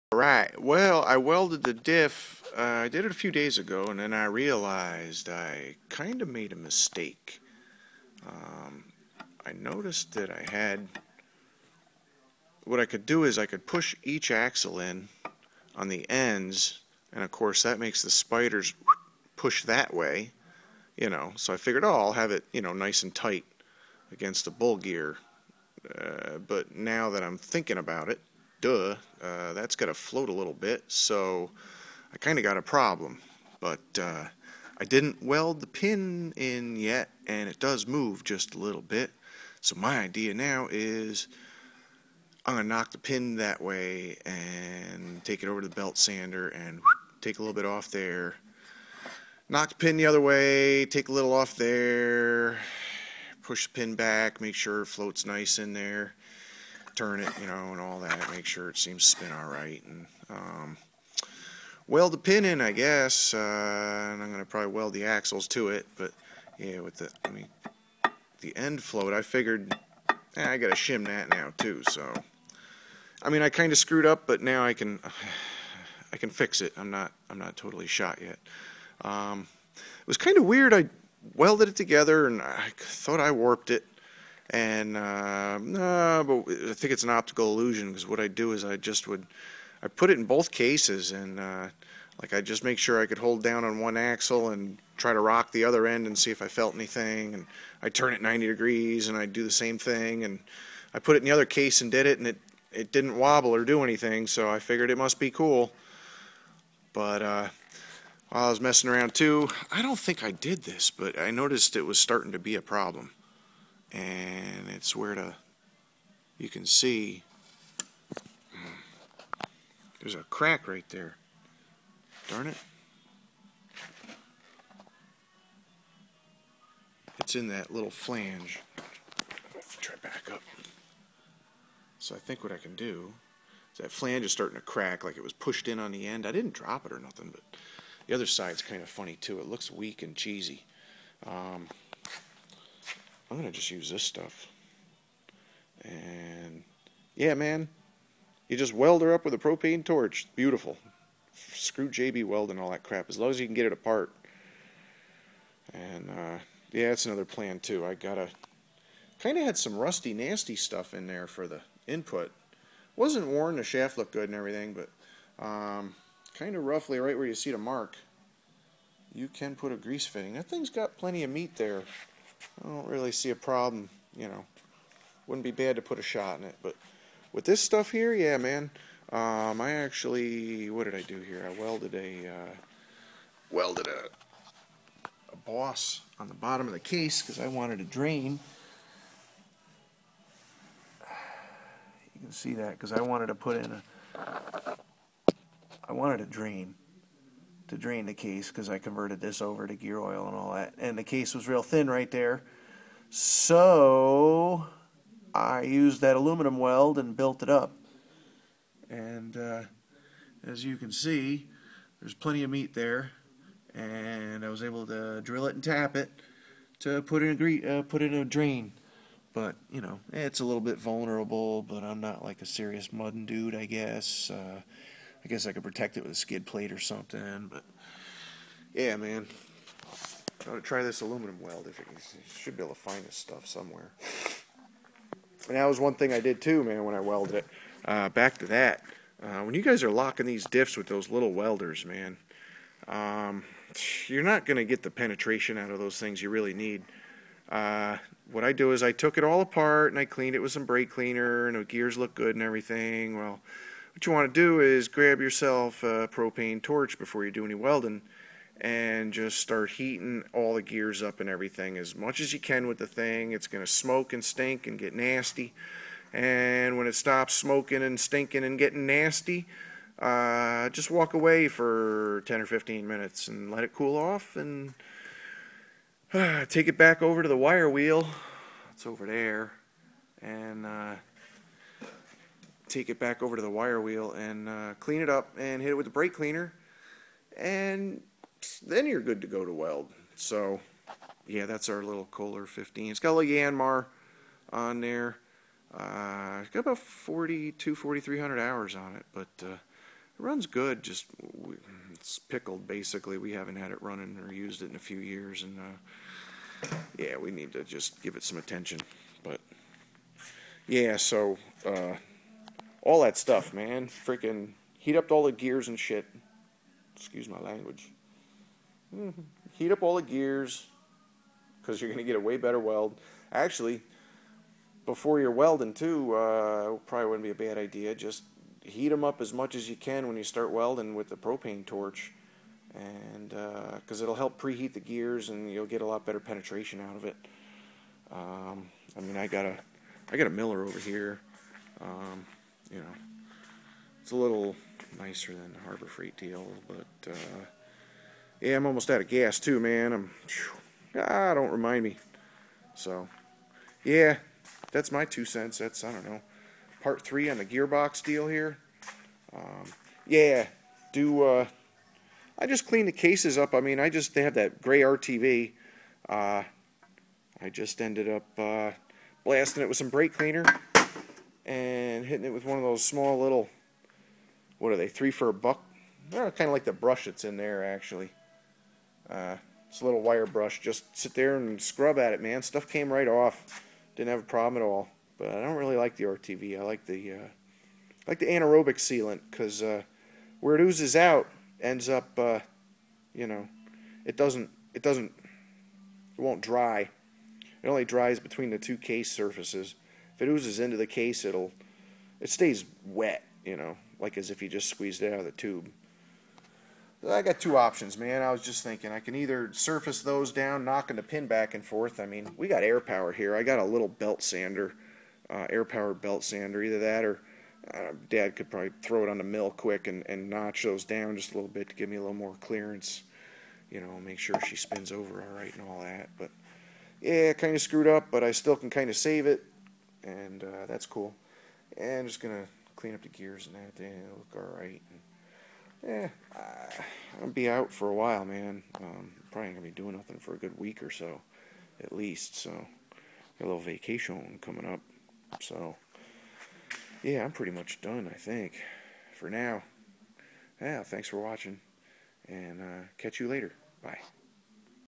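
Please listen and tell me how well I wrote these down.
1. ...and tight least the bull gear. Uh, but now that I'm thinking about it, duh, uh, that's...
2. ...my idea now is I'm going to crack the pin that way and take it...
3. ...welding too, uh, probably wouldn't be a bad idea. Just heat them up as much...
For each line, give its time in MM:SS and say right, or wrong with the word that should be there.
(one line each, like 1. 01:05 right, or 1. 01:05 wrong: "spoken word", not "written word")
1. 00:23 wrong: "against", not "least"
2. 00:39 wrong: "knock", not "crack"
3. 05:25 right.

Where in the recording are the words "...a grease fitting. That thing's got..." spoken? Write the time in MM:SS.
02:49.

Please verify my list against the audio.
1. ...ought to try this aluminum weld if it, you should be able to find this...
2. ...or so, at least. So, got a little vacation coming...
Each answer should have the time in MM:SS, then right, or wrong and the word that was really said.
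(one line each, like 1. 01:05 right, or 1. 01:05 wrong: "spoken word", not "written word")
1. 03:50 right
2. 07:20 right.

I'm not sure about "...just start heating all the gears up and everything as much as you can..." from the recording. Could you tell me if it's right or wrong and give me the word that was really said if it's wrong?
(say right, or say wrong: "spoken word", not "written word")
right.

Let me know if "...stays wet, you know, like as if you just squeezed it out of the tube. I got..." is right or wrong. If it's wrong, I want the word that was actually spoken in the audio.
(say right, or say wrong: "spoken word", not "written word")
right.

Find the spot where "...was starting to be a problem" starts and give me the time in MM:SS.
01:51.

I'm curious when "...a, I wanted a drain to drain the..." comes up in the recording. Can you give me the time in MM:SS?
03:13.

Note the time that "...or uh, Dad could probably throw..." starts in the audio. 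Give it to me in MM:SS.
06:57.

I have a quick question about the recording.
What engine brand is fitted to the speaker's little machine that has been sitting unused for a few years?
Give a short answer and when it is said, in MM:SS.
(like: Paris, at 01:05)
Yanmar, at 04:53.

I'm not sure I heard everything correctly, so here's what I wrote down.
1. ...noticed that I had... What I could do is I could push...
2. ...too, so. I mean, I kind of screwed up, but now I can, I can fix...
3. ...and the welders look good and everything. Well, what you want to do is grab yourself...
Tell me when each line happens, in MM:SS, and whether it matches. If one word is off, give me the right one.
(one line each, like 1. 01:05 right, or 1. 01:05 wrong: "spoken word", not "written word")
1. 00:09 right
2. 01:11 right
3. 04:11 wrong: "gears", not "welders".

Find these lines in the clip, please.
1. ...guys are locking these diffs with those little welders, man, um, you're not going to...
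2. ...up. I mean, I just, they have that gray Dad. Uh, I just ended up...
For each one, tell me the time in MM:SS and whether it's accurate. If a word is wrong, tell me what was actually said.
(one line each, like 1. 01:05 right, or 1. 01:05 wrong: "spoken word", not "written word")
1. 03:59 right
2. 06:03 wrong: "RTV", not "Dad".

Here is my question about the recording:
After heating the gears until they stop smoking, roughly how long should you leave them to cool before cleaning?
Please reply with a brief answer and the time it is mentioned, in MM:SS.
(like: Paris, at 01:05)
10 or 15 minutes, at 04:32.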